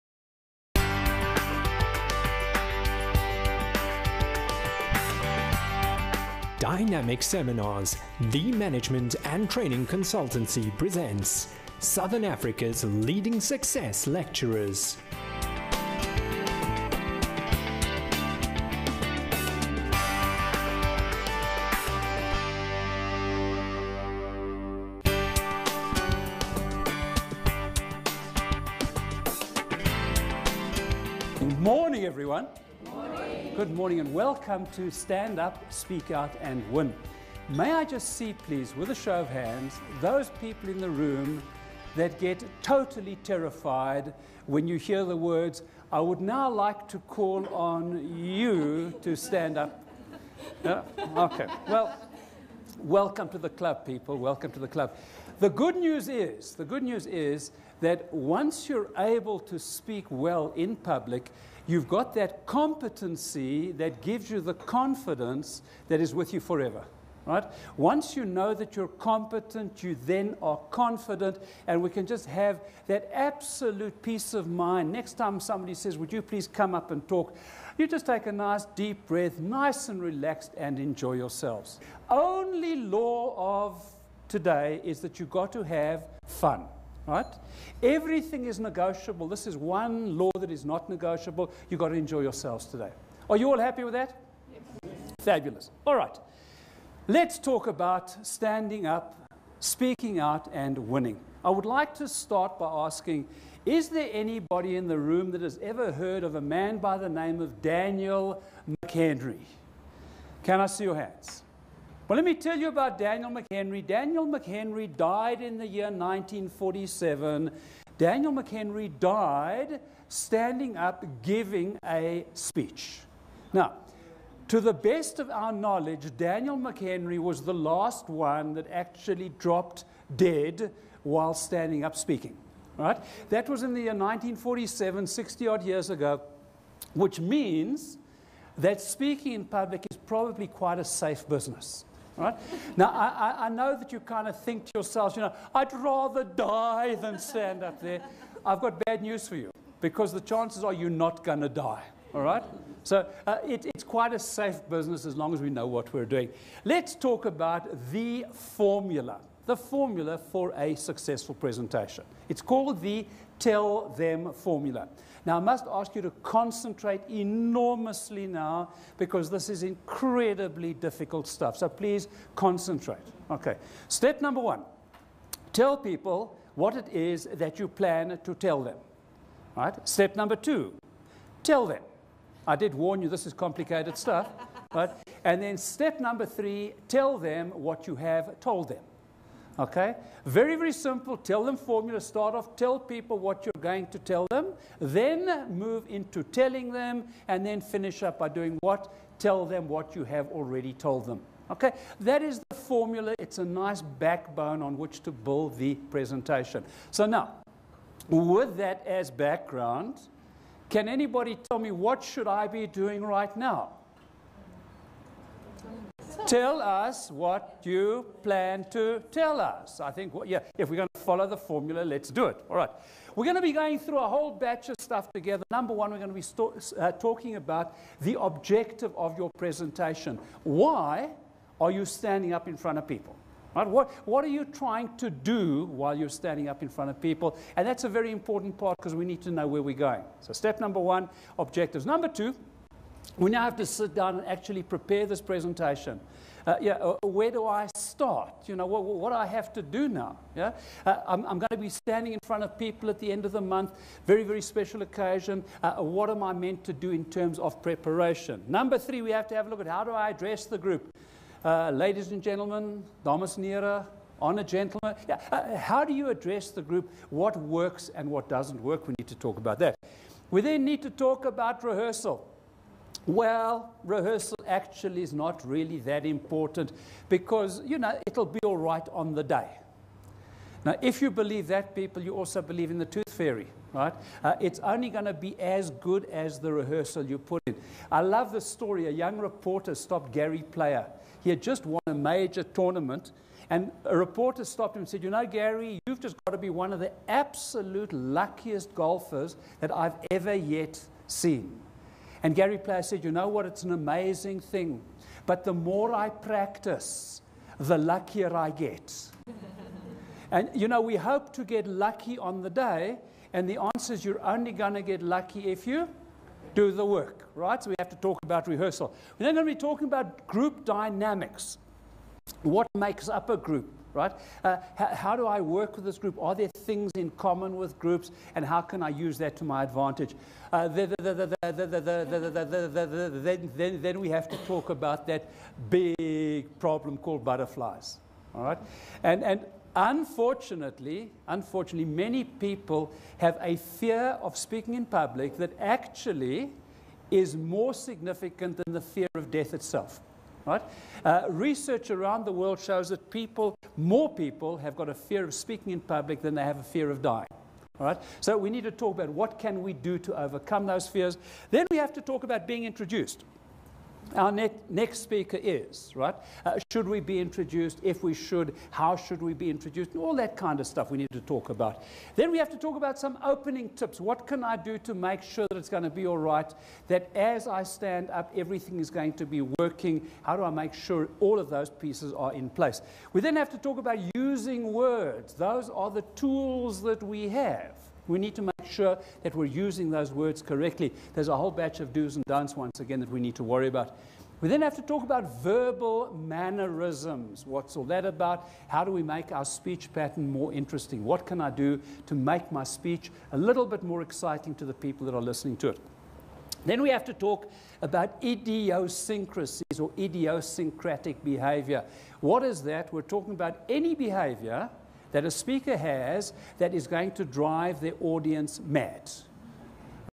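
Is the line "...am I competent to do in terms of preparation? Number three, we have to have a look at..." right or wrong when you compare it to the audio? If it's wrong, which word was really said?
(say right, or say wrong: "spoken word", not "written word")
wrong: "meant", not "competent".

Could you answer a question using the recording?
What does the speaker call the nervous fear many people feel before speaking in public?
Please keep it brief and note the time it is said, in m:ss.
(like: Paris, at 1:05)
butterflies, at 5:37.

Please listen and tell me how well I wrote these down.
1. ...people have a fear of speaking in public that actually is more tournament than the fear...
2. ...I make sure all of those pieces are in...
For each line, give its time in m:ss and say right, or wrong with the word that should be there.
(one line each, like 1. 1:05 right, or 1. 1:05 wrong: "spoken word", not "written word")
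1. 5:42 wrong: "significant", not "tournament"
2. 6:20 right.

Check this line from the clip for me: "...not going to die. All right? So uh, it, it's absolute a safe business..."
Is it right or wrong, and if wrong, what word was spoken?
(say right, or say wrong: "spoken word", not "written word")
wrong: "quite", not "absolute".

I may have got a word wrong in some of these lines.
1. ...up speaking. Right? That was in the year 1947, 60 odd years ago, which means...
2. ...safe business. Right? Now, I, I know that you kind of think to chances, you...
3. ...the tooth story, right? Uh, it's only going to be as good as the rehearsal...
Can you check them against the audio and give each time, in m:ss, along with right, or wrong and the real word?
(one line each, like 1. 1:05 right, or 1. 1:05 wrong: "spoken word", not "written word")
1. 2:11 right
2. 2:20 wrong: "yourselves", not "chances"
3. 4:42 wrong: "fairy", not "story".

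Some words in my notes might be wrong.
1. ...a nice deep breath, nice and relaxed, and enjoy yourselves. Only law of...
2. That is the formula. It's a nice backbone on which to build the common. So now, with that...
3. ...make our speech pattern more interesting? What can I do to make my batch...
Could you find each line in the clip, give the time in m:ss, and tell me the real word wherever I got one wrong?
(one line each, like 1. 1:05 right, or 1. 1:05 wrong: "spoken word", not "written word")
1. 1:18 right
2. 3:21 wrong: "presentation", not "common"
3. 6:39 wrong: "speech", not "batch".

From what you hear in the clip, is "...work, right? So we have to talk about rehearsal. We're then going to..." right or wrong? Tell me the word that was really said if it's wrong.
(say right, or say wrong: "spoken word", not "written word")
right.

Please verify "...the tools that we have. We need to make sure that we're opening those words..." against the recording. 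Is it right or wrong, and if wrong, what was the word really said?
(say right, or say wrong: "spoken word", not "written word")
wrong: "using", not "opening".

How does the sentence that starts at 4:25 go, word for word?
Yeah, how do you address the group?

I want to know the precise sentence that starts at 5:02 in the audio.
And Gary Player said, You know what?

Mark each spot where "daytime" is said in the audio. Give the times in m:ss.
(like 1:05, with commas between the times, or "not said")
not said.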